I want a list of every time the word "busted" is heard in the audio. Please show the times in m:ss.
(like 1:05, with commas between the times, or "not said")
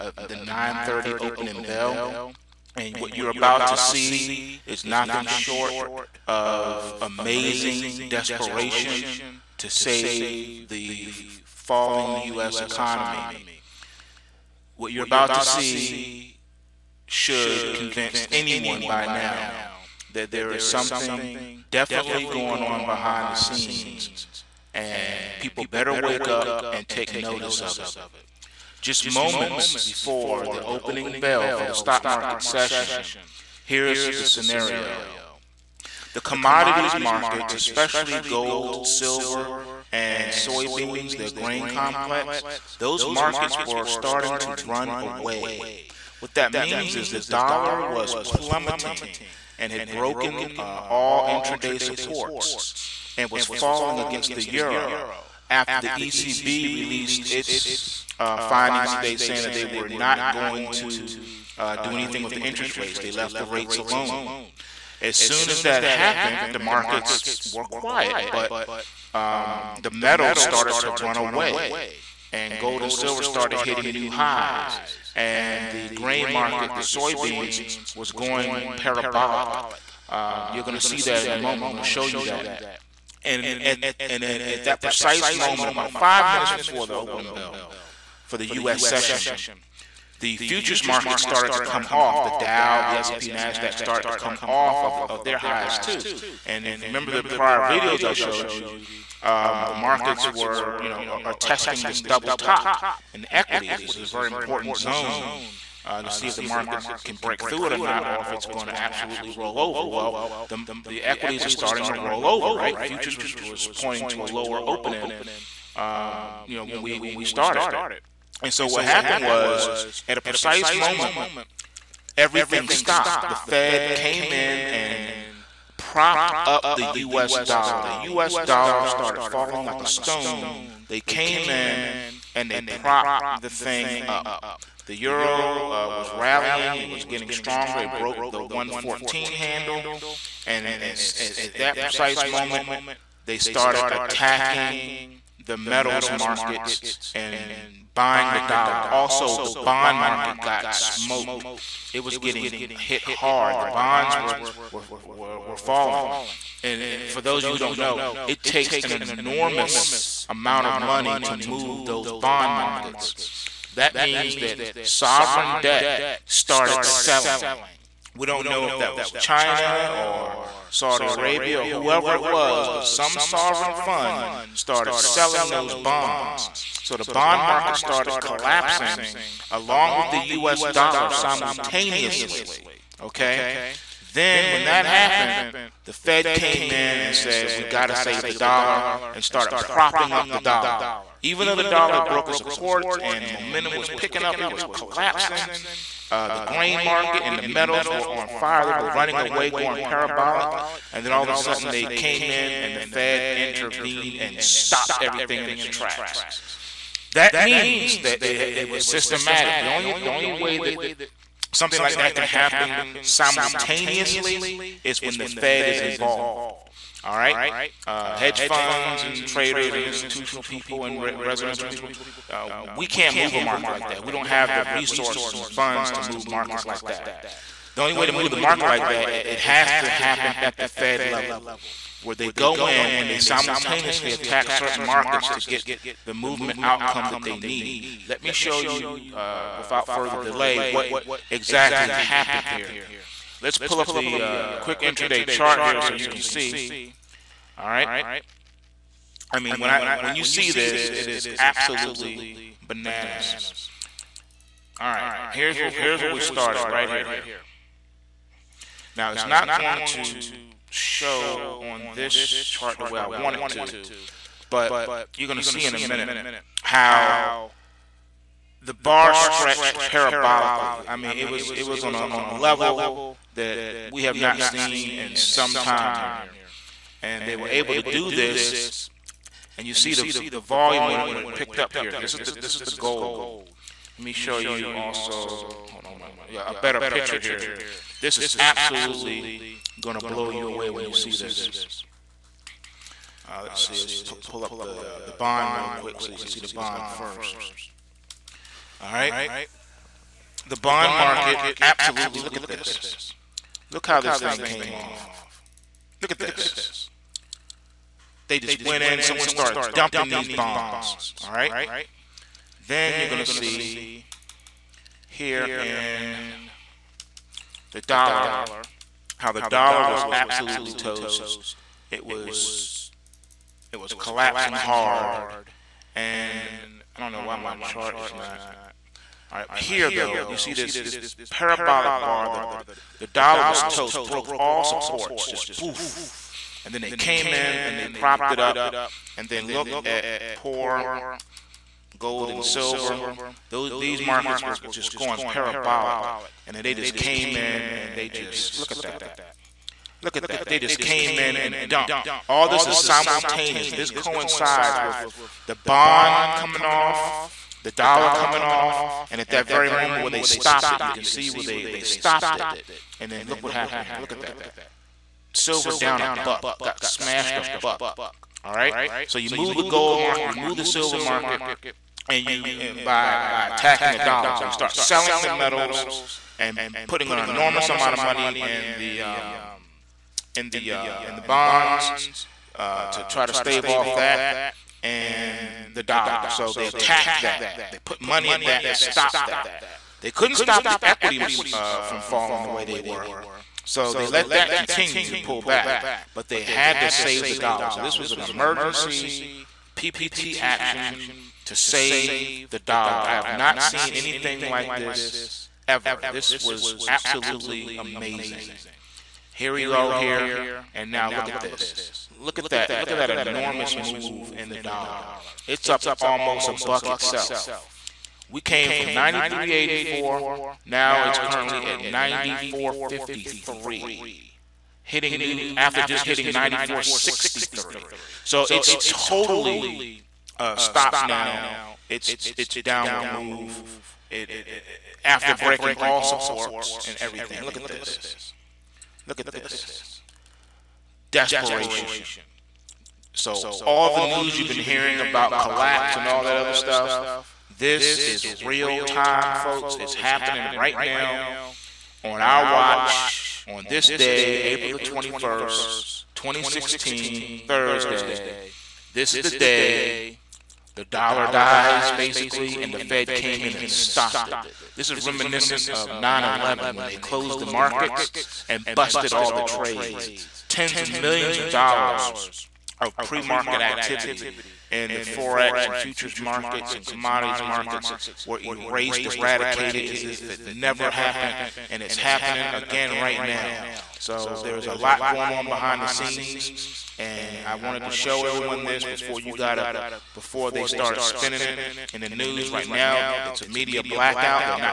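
7:48.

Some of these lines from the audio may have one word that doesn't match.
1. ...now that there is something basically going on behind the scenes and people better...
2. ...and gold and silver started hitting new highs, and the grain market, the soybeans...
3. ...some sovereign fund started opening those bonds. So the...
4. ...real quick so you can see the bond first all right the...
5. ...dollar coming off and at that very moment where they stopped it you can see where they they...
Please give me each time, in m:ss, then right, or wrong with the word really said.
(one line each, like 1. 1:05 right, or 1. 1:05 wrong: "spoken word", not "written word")
1. 0:19 wrong: "definitely", not "basically"
2. 1:12 right
3. 2:52 wrong: "selling", not "opening"
4. 4:55 right
5. 5:57 right.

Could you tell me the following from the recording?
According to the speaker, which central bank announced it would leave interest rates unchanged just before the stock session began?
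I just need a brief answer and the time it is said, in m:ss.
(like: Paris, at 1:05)
ECB, at 0:55.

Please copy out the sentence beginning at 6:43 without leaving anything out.
I have not seen anything like this ever.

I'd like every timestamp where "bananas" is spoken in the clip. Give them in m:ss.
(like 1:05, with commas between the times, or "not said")
4:12.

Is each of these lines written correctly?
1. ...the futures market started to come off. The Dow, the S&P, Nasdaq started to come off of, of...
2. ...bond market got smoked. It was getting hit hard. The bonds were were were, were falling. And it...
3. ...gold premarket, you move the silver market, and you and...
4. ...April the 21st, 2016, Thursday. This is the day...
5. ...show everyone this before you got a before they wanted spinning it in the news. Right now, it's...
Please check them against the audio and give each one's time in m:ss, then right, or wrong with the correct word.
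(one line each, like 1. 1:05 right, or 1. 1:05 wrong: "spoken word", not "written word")
1. 1:30 right
2. 2:29 right
3. 6:09 wrong: "market", not "premarket"
4. 7:34 right
5. 8:07 wrong: "started", not "wanted".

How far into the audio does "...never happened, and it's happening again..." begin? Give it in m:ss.
8:00.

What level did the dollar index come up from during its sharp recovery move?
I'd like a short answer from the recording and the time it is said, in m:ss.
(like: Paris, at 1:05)
93.84, at 6:58.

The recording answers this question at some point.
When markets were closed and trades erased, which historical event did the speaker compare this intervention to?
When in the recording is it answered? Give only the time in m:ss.
7:45.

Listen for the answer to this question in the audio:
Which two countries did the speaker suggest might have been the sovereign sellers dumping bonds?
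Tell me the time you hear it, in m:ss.
2:49.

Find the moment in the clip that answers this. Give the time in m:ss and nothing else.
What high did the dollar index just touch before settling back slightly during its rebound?
7:06.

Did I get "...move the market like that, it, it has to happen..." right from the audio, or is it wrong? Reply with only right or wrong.
right.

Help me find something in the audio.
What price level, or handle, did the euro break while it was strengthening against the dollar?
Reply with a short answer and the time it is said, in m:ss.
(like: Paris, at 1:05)
114, at 2:18.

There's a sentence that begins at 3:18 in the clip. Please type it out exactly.
They were running away, going parabolic.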